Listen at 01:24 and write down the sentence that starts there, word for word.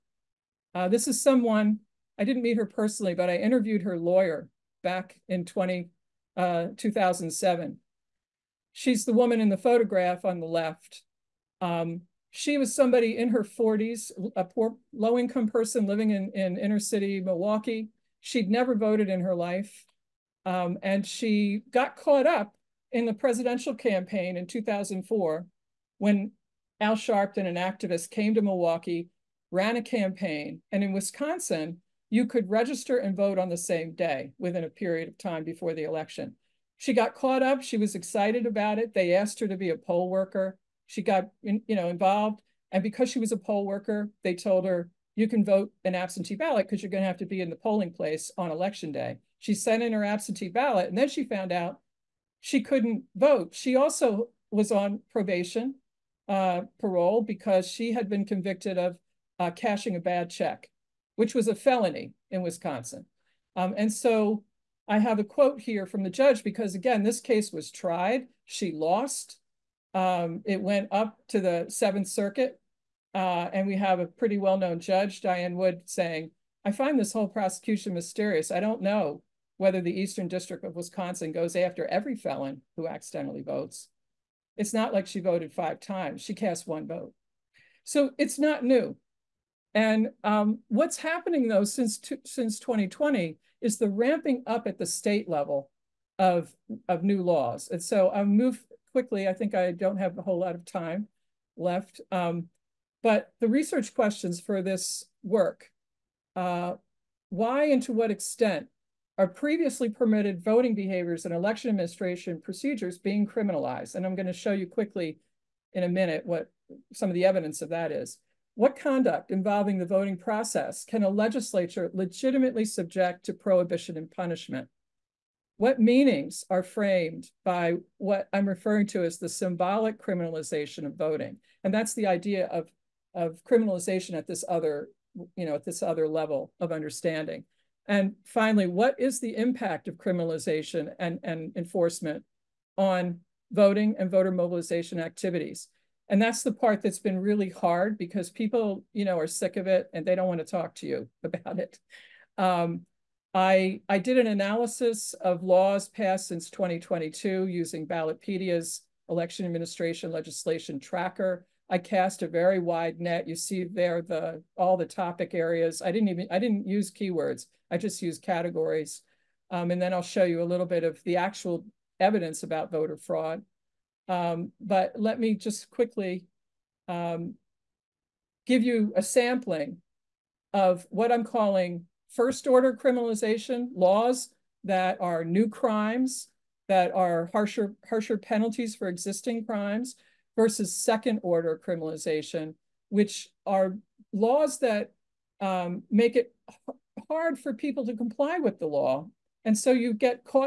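It's not like she voted five times; she cast one vote.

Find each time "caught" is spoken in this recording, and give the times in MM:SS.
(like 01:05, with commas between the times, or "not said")
00:21, 00:37.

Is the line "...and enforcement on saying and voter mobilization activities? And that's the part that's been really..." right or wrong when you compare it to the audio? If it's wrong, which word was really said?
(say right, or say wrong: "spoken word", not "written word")
wrong: "voting", not "saying".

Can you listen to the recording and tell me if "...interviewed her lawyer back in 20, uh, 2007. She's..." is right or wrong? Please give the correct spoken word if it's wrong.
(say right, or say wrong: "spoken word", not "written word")
right.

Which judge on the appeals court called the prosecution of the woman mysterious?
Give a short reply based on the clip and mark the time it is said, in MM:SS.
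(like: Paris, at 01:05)
Diane Wood, at 01:15.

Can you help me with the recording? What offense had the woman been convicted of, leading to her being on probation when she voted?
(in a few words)
Cashing a bad check.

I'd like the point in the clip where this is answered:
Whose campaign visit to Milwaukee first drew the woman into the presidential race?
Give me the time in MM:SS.
00:26.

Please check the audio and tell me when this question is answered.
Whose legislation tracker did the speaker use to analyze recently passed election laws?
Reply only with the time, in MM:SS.
02:37.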